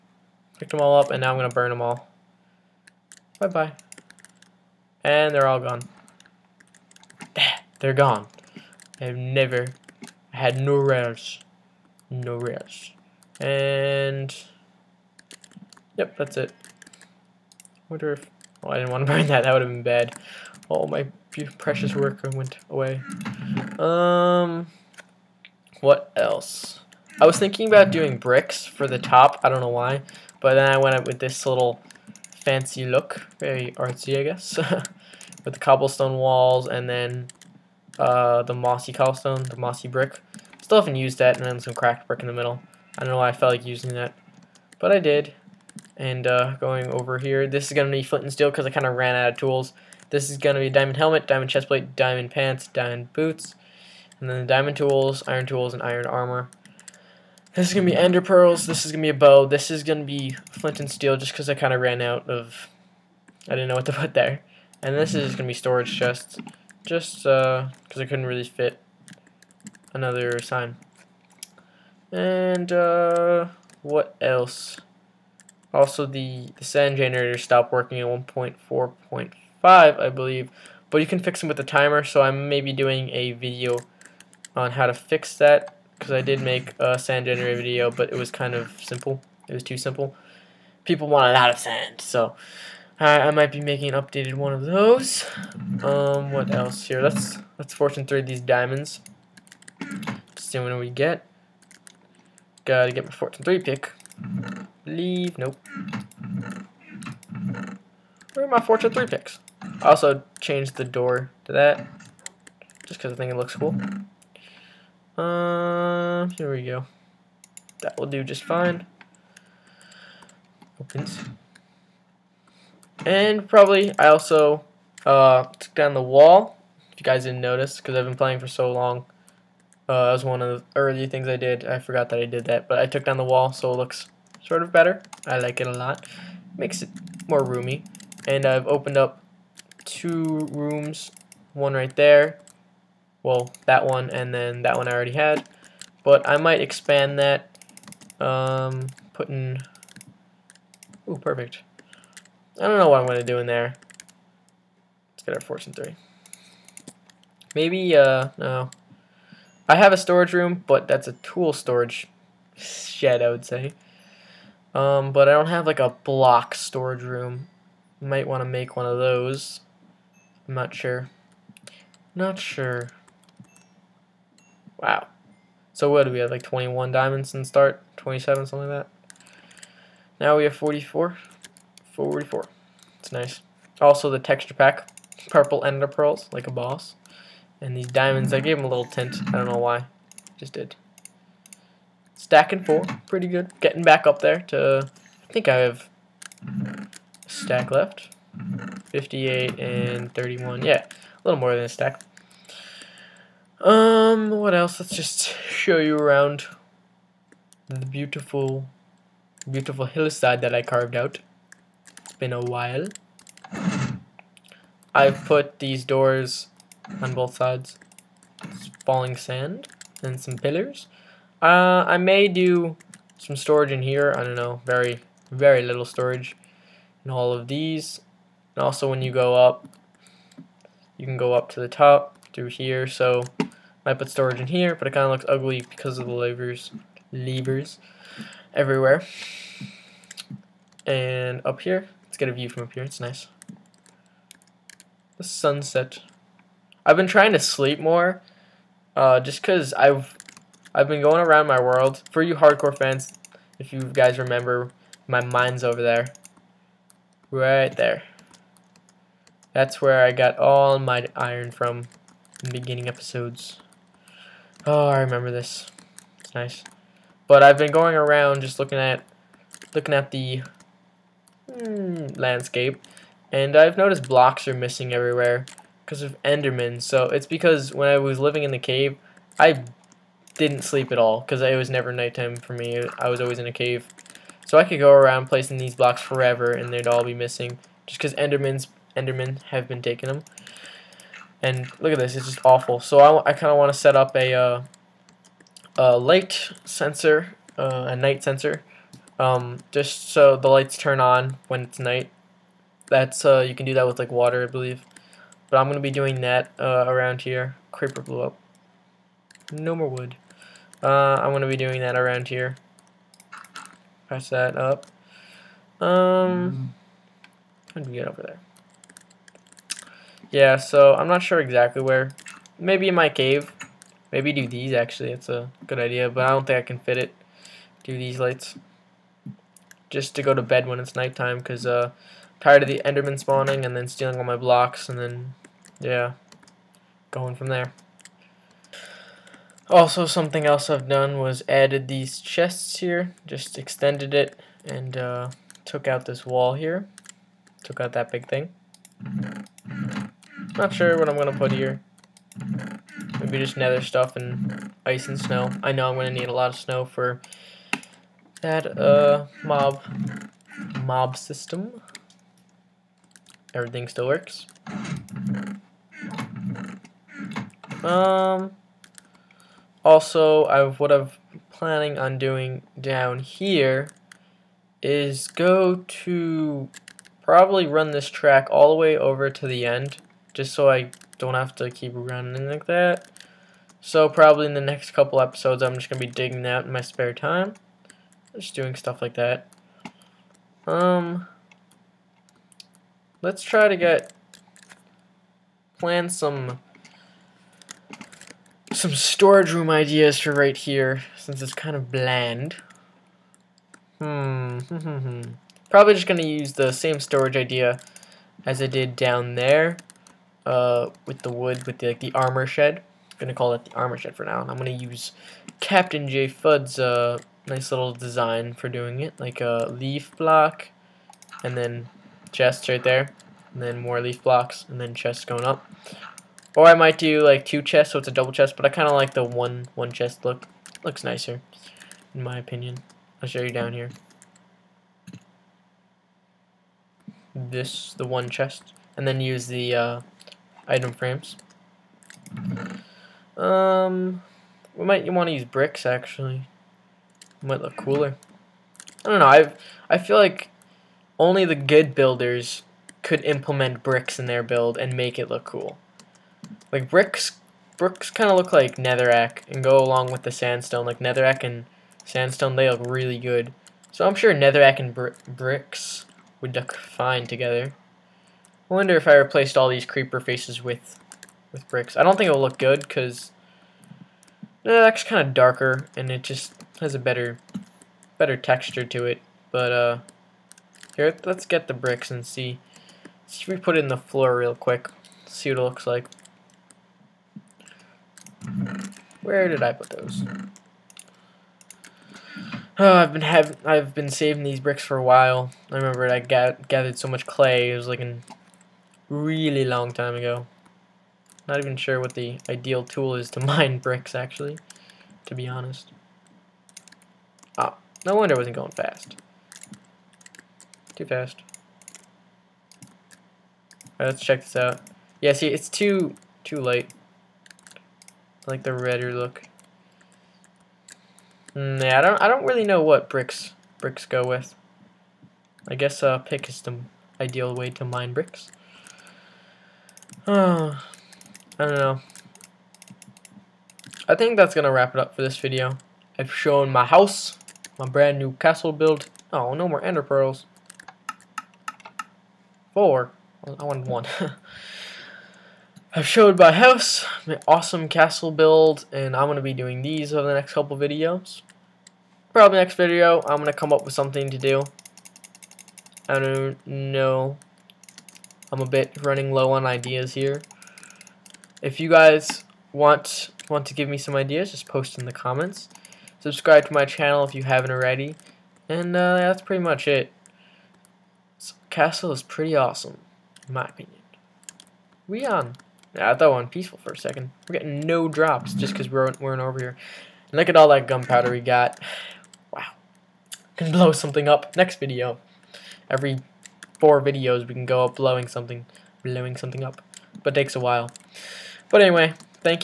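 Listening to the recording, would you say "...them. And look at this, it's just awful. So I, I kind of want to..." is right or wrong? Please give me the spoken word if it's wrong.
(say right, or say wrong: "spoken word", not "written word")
right.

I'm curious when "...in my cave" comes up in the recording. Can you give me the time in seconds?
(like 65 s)
322 s.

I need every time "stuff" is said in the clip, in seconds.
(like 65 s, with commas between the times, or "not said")
353 s, 388 s.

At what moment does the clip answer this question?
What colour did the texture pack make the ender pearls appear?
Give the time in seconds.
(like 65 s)
185 s.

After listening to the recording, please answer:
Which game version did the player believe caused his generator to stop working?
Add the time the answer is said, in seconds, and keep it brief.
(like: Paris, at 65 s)
1.4.5, at 78 s.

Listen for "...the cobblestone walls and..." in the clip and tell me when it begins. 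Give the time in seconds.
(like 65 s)
35 s.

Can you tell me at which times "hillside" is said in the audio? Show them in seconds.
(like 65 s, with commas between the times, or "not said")
209 s.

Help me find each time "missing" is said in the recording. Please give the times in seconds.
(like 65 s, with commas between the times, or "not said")
274 s, 287 s.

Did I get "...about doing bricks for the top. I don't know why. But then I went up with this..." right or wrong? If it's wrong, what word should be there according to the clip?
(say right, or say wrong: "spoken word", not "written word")
right.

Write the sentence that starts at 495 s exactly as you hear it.
I remember I got gathered so much clay.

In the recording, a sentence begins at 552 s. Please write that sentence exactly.
Probably next video, I'm gonna come up with something to do.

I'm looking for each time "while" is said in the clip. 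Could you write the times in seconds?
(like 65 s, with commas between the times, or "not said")
212 s, 495 s, 590 s.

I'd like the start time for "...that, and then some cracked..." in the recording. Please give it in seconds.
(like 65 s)
41 s.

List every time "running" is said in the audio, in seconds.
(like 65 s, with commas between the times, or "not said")
381 s, 559 s.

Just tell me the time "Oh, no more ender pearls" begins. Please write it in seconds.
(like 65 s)
539 s.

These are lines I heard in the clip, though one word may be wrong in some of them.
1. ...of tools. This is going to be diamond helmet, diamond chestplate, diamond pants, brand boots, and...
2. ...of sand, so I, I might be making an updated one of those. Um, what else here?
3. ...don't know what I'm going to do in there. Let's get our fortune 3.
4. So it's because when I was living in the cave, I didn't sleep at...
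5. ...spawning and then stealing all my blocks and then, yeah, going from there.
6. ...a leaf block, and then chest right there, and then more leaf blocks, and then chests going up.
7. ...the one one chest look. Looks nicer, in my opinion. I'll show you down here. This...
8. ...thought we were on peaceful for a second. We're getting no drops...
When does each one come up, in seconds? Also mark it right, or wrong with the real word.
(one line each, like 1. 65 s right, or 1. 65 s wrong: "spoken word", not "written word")
1. 49 s wrong: "diamond", not "brand"
2. 91 s right
3. 152 s right
4. 276 s right
5. 333 s right
6. 419 s right
7. 429 s right
8. 576 s right.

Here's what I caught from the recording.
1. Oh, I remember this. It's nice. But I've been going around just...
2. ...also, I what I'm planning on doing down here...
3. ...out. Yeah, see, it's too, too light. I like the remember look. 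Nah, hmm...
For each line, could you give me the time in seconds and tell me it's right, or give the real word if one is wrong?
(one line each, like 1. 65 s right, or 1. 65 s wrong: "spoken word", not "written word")
1. 264 s right
2. 369 s right
3. 514 s wrong: "redder", not "remember".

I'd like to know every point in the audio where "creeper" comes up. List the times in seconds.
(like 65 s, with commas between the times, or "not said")
307 s, 469 s.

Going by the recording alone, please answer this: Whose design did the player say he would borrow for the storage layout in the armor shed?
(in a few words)
Captain J Fudd.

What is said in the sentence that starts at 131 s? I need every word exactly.
I forgot that I did that, but I took down the wall, so it looks sort of better.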